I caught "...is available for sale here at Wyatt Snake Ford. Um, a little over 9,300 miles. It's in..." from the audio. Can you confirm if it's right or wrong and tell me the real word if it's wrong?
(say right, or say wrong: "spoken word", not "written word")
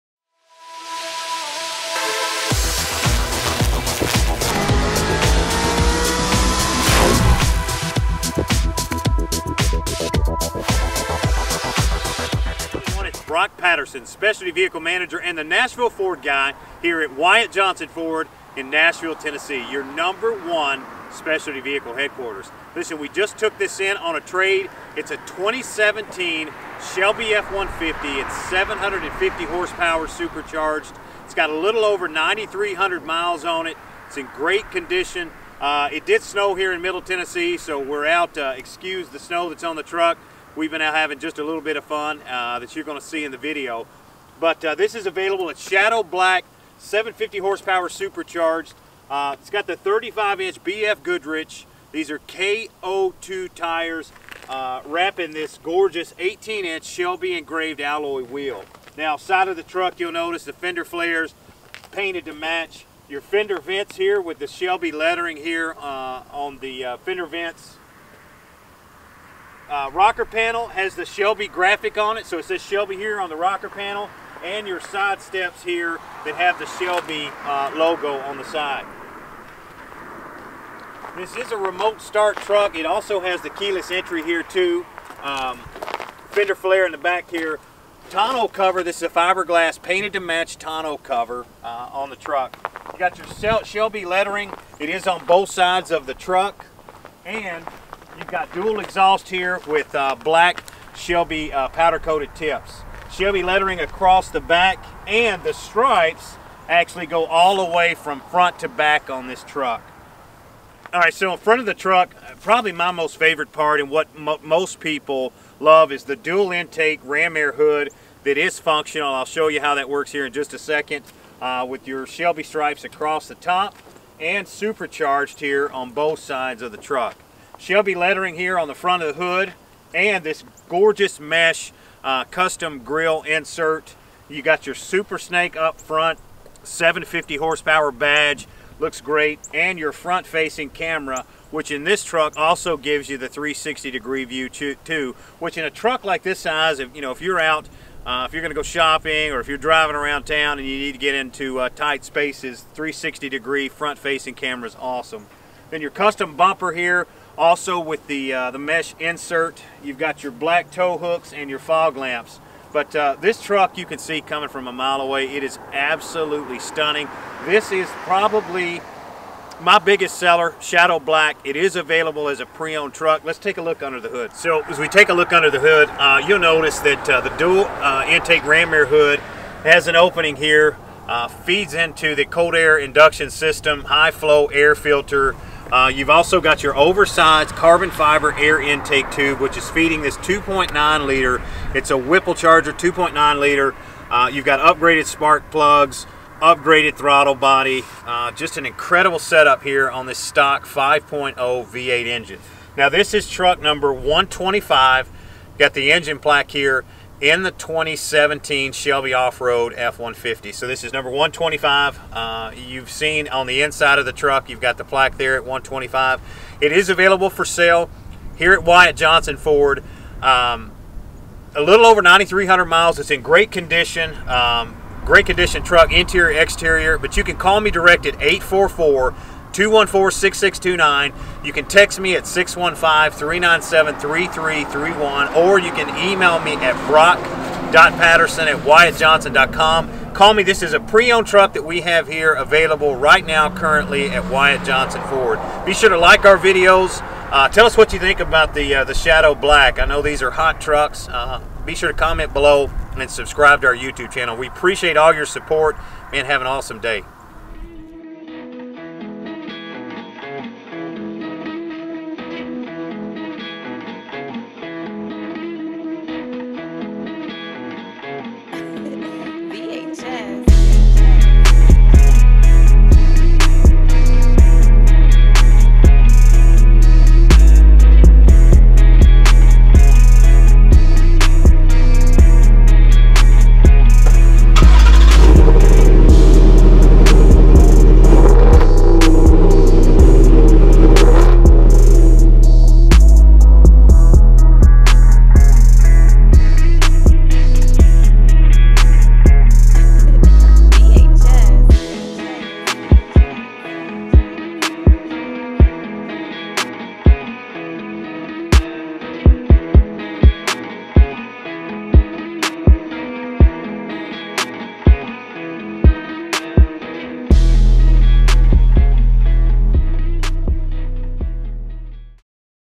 wrong: "Johnson", not "Snake".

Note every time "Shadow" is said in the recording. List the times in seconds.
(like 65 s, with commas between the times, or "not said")
45 s, 170 s, 248 s.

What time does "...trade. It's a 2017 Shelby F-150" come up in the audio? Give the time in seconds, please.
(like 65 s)
24 s.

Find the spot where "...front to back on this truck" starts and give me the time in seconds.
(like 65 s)
108 s.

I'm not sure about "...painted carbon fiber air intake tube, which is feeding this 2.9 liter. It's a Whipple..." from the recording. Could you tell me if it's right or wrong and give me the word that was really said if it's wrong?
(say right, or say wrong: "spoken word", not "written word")
wrong: "oversized", not "painted".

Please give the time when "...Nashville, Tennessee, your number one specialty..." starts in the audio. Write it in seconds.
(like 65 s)
18 s.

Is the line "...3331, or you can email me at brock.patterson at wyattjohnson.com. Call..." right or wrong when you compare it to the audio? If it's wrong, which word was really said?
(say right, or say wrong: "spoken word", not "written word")
right.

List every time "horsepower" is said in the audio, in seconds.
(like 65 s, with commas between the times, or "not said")
29 s, 47 s, 137 s.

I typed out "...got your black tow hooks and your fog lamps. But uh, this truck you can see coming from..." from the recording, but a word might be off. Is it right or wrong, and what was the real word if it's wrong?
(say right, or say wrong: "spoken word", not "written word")
right.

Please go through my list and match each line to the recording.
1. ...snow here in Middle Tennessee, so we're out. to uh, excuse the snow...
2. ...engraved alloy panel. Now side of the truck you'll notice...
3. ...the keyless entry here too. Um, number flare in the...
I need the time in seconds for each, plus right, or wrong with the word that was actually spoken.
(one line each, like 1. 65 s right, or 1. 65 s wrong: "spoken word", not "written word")
1. 36 s right
2. 57 s wrong: "wheel", not "panel"
3. 83 s wrong: "fender", not "number".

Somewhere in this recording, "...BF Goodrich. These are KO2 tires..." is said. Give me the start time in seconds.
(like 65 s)
50 s.